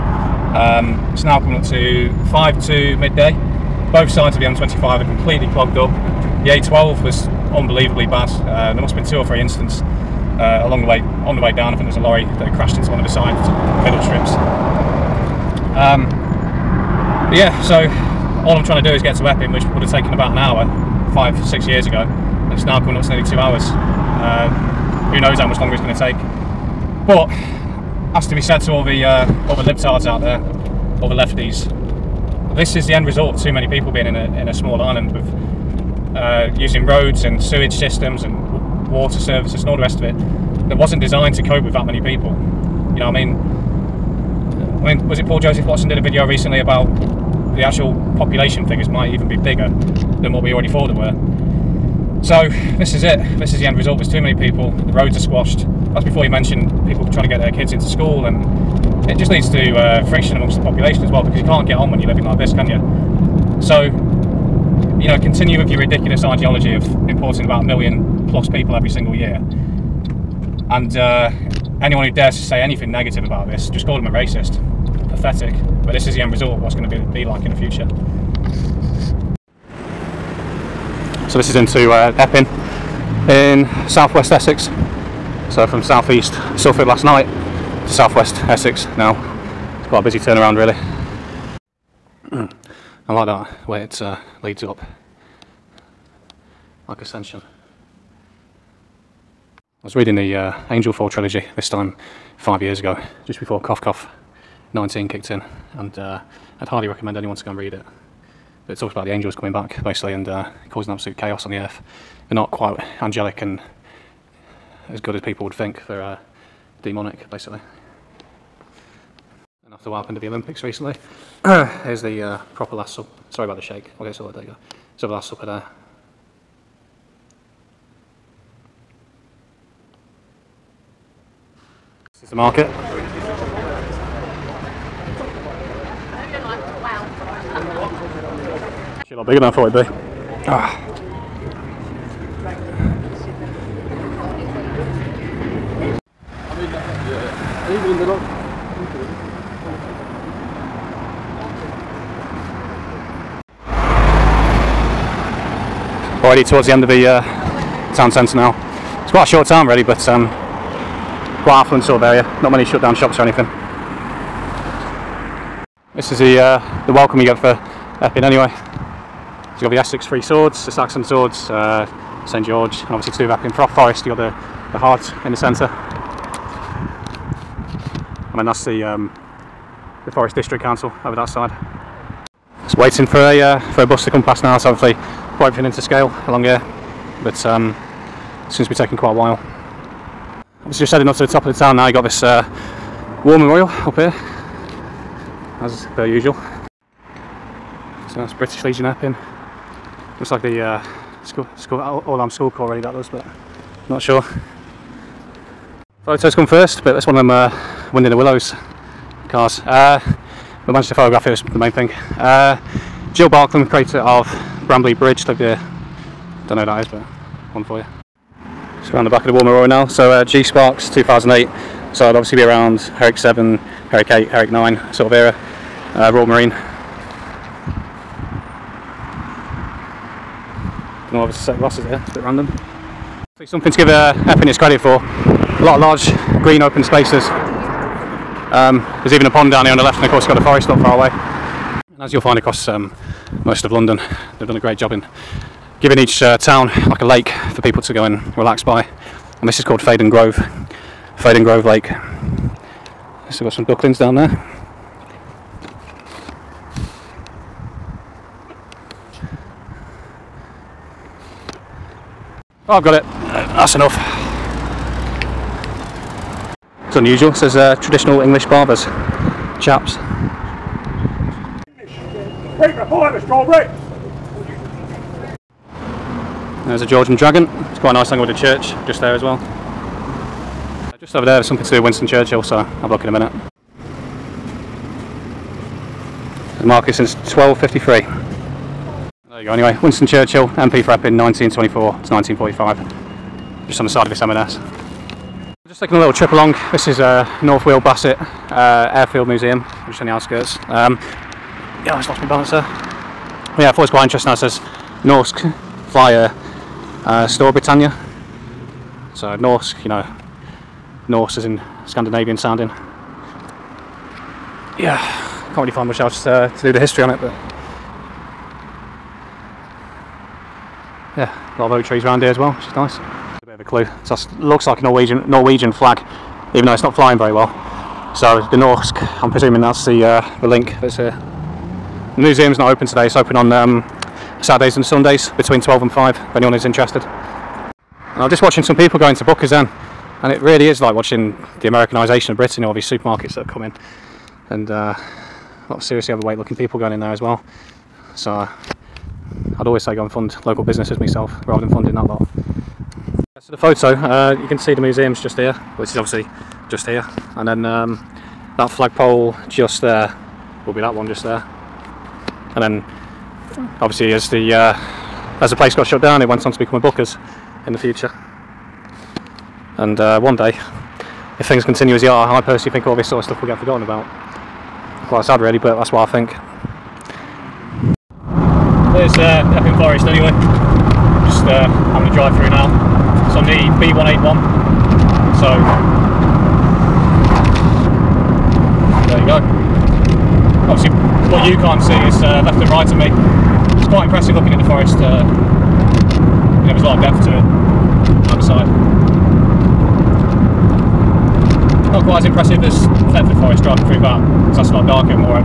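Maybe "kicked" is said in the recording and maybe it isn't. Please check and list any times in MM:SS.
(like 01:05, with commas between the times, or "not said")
01:45.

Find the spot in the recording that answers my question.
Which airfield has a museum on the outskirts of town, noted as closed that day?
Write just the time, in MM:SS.
04:57.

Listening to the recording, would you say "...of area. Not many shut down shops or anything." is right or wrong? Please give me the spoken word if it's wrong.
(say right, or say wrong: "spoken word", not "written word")
right.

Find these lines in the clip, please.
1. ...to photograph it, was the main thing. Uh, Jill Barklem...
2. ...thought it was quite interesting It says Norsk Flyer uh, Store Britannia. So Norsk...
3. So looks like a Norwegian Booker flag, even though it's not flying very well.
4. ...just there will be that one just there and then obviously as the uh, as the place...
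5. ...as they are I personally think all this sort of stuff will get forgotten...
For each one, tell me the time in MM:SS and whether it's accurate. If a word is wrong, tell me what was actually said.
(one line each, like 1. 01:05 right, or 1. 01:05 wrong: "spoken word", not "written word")
1. 03:30 right
2. 05:03 right
3. 05:24 wrong: "Norwegian", not "Booker"
4. 05:59 right
5. 06:11 right.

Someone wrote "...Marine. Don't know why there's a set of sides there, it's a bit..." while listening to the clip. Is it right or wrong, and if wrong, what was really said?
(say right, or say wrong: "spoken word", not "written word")
wrong: "glasses", not "sides".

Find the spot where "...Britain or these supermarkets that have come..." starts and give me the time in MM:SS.
05:42.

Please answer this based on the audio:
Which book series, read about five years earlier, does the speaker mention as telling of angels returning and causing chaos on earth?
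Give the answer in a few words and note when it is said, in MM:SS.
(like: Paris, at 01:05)
Angel Fall trilogy, at 01:40.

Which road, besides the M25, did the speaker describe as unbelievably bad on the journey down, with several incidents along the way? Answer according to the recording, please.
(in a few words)
A12.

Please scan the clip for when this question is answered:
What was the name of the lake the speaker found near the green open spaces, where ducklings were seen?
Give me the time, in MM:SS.
04:11.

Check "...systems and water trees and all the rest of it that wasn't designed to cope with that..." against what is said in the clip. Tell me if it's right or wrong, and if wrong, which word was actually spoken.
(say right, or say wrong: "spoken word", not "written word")
wrong: "services", not "trees".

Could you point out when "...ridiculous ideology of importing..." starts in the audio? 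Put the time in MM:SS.
01:05.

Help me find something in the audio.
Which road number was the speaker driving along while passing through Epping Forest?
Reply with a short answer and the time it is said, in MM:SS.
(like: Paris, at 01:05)
B181, at 06:23.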